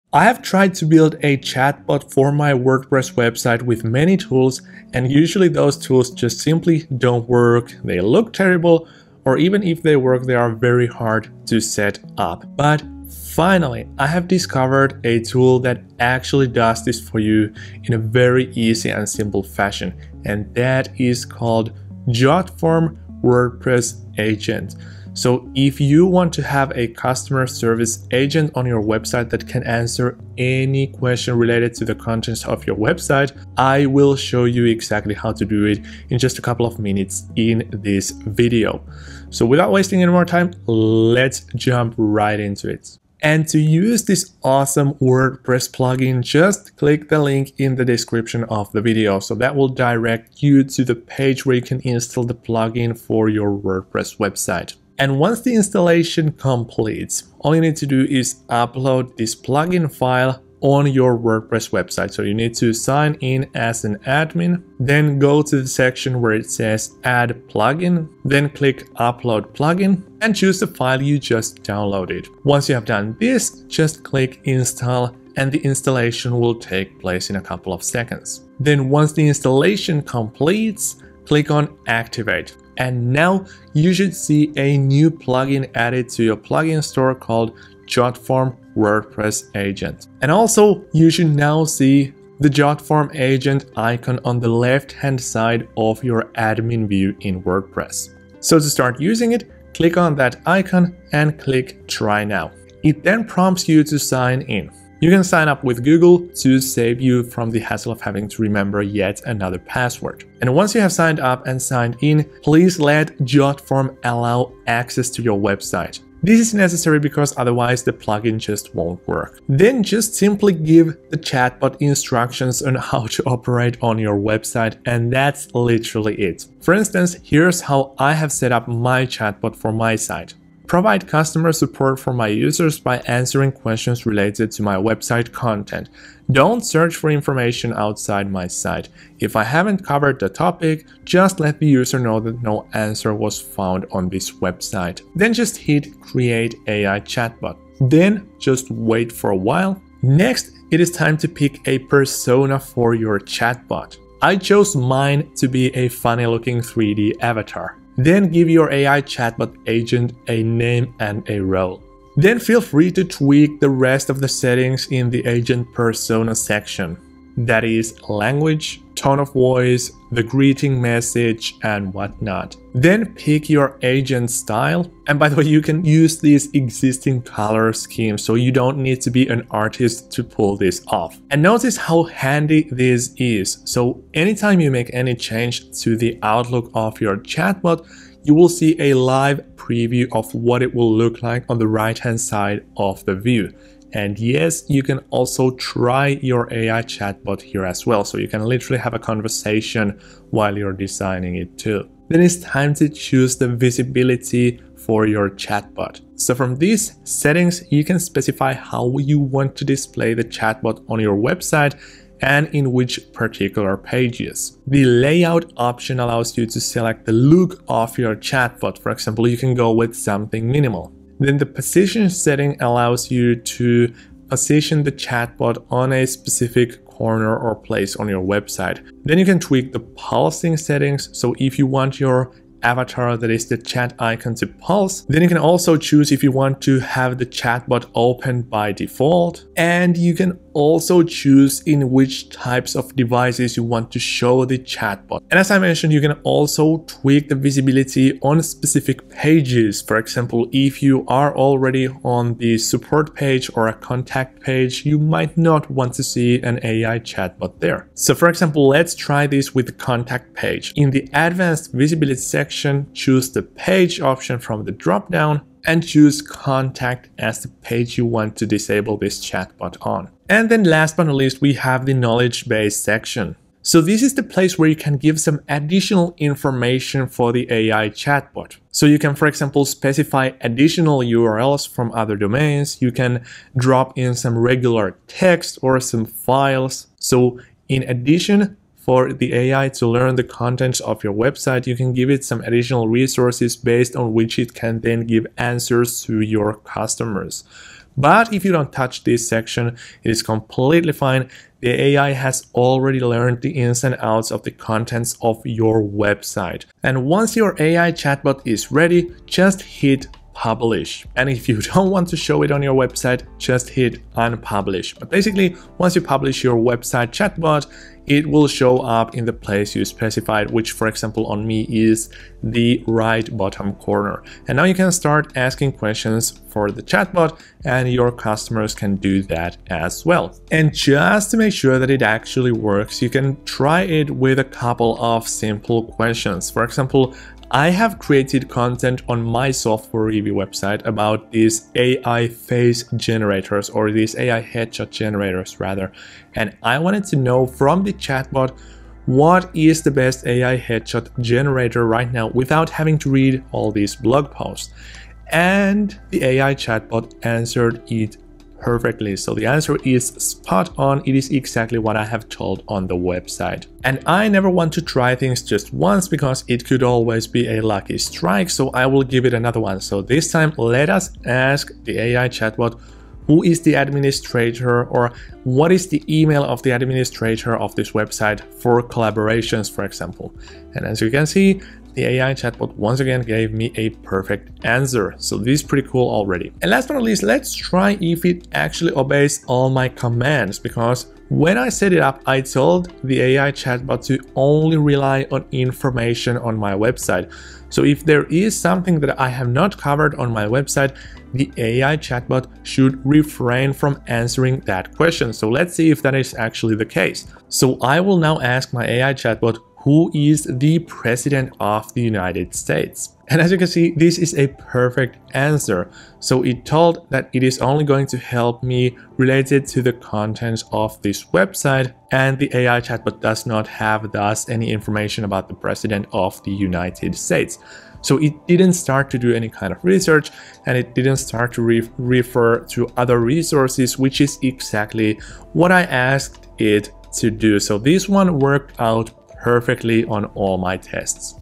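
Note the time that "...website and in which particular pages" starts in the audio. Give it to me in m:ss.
3:31.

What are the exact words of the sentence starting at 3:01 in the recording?
And notice how handy this is.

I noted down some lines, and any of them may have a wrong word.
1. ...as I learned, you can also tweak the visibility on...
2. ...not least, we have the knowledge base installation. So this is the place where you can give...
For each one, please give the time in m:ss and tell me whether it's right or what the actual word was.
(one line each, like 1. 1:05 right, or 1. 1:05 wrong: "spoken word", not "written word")
1. 4:05 wrong: "mentioned", not "learned"
2. 4:31 wrong: "section", not "installation".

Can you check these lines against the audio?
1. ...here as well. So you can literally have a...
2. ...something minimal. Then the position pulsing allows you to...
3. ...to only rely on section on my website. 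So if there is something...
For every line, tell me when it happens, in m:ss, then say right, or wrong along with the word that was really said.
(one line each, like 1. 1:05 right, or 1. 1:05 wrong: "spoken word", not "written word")
1. 3:17 right
2. 3:39 wrong: "setting", not "pulsing"
3. 6:34 wrong: "information", not "section".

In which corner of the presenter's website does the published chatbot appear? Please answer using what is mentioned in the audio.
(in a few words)
right bottom corner.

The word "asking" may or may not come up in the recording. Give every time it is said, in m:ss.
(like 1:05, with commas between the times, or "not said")
5:25.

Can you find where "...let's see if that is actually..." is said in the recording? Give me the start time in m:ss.
6:45.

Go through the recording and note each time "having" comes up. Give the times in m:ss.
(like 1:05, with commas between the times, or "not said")
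1:47, 5:52.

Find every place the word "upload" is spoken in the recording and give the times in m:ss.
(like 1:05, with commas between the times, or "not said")
0:58, 1:08.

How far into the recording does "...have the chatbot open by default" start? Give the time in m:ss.
3:56.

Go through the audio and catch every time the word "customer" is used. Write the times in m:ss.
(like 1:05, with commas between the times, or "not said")
0:26, 2:11, 4:56, 5:28.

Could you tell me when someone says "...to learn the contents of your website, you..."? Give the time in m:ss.
4:49.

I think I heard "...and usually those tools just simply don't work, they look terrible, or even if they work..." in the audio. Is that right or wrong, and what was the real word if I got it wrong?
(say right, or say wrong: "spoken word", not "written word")
right.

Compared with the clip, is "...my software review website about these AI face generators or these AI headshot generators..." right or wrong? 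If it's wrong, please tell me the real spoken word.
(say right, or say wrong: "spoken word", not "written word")
right.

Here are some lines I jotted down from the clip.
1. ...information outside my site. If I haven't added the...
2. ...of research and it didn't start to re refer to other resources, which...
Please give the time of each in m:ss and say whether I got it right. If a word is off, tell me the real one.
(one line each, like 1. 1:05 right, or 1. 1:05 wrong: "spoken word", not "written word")
1. 2:17 wrong: "covered", not "added"
2. 7:09 right.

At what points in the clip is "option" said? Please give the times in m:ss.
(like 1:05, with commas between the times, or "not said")
3:35, 4:24.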